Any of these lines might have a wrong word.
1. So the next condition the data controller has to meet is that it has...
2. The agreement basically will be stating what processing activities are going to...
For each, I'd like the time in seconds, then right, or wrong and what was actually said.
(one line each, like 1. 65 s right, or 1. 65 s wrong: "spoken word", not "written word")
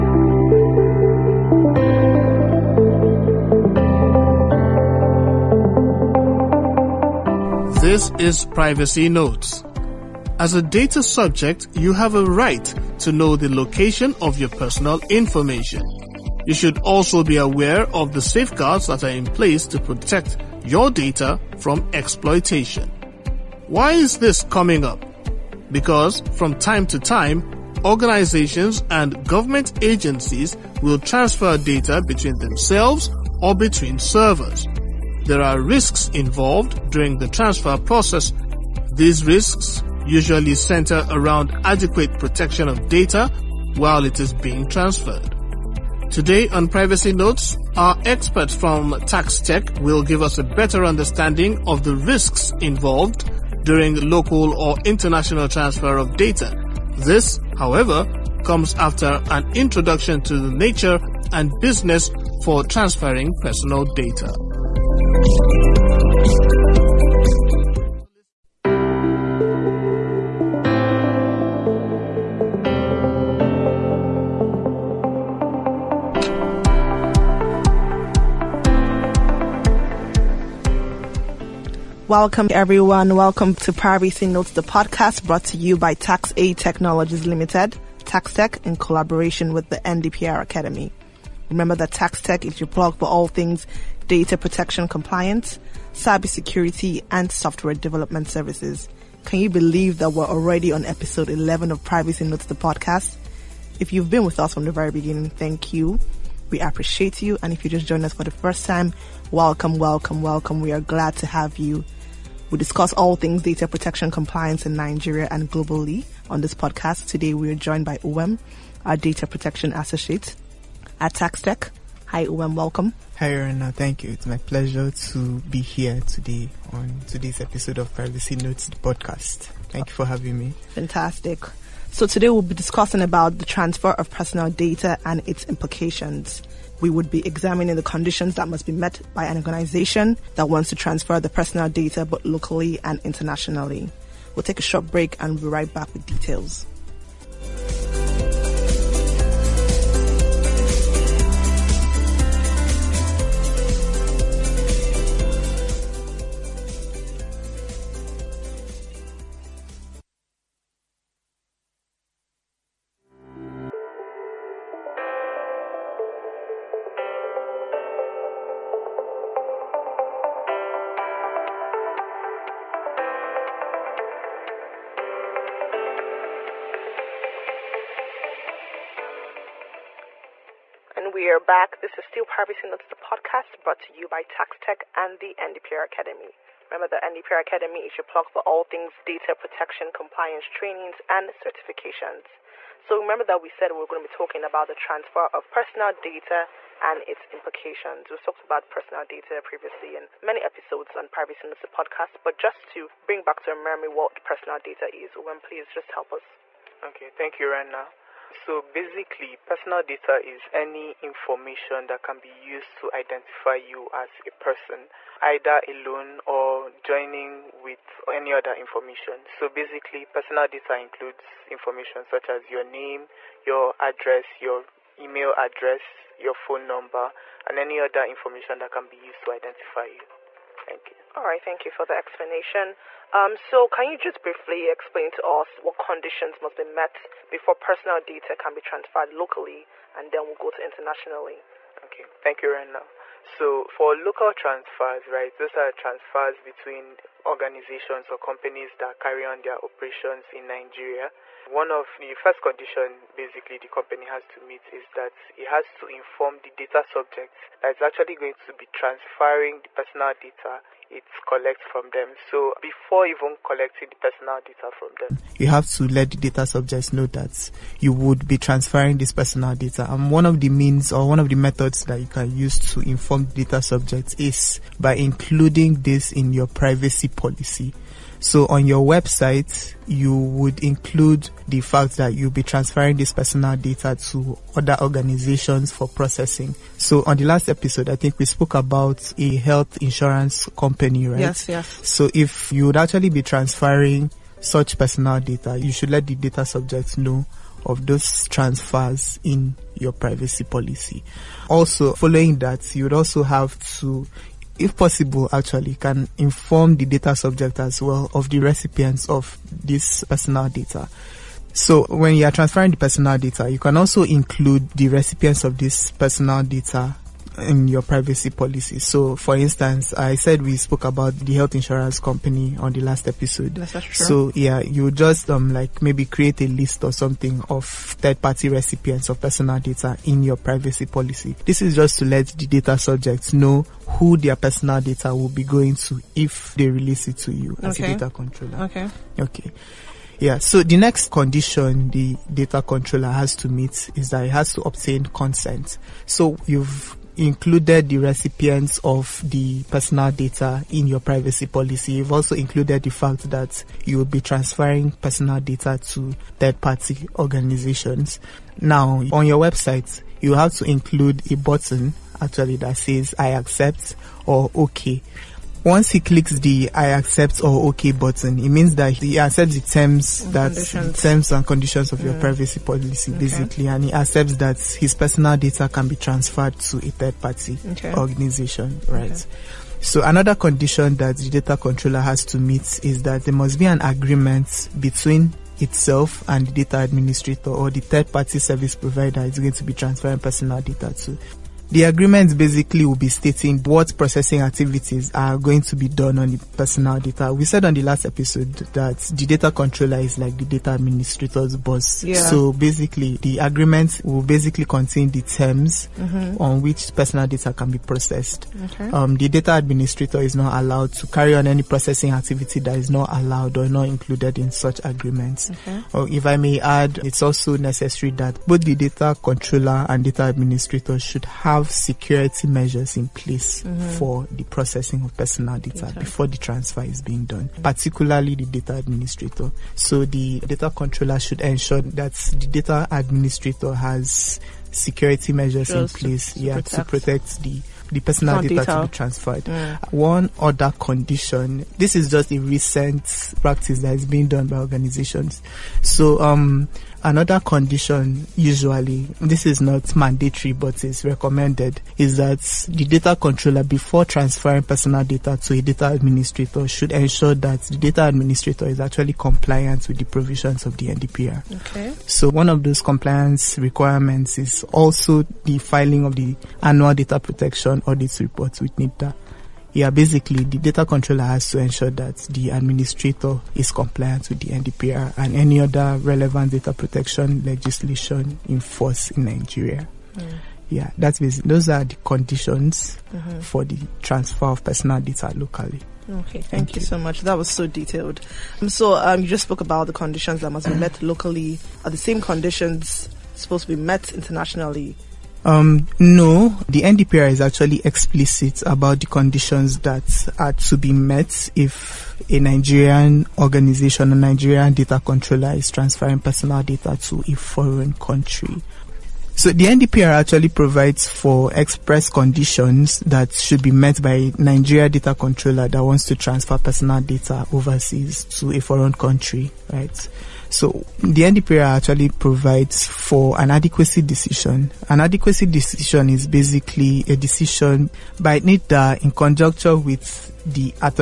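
1. 340 s right
2. 391 s right.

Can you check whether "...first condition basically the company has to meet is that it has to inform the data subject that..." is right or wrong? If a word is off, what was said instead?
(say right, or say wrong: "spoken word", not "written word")
right.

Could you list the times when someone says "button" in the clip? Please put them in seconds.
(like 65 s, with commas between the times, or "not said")
361 s, 367 s.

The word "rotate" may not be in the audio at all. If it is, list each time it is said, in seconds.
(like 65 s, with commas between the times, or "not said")
not said.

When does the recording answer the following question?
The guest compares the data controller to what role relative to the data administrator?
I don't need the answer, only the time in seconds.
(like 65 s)
401 s.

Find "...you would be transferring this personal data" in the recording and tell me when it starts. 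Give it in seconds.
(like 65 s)
267 s.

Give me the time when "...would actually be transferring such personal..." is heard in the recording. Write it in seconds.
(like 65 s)
292 s.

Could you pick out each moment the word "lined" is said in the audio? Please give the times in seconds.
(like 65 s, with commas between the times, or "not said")
not said.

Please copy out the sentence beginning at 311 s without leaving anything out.
So when you are transferring the personal data, you can also include the recipients of this personal data in your privacy policy.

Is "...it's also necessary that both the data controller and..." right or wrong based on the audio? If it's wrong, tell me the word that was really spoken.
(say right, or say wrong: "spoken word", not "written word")
right.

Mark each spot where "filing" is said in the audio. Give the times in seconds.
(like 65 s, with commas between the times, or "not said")
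465 s.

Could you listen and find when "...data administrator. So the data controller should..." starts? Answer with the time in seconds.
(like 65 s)
428 s.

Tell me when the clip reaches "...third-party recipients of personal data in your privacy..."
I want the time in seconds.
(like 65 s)
327 s.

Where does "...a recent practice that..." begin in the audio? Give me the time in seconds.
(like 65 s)
442 s.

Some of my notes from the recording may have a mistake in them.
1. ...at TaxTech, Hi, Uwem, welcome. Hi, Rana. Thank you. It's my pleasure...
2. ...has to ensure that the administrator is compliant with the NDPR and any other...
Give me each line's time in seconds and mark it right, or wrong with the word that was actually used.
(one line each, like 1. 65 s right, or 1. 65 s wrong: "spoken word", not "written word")
1. 120 s right
2. 471 s right.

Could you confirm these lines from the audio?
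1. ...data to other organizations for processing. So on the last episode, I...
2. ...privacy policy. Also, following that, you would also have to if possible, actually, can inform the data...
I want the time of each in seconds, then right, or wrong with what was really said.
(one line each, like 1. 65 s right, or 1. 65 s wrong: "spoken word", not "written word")
1. 283 s right
2. 299 s right.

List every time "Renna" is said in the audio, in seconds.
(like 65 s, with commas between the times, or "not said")
207 s, 242 s.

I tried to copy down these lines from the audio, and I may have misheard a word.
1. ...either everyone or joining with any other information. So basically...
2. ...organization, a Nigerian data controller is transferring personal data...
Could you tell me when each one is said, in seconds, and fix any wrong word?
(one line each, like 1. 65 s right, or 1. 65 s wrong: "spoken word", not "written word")
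1. 215 s wrong: "alone", not "everyone"
2. 503 s right.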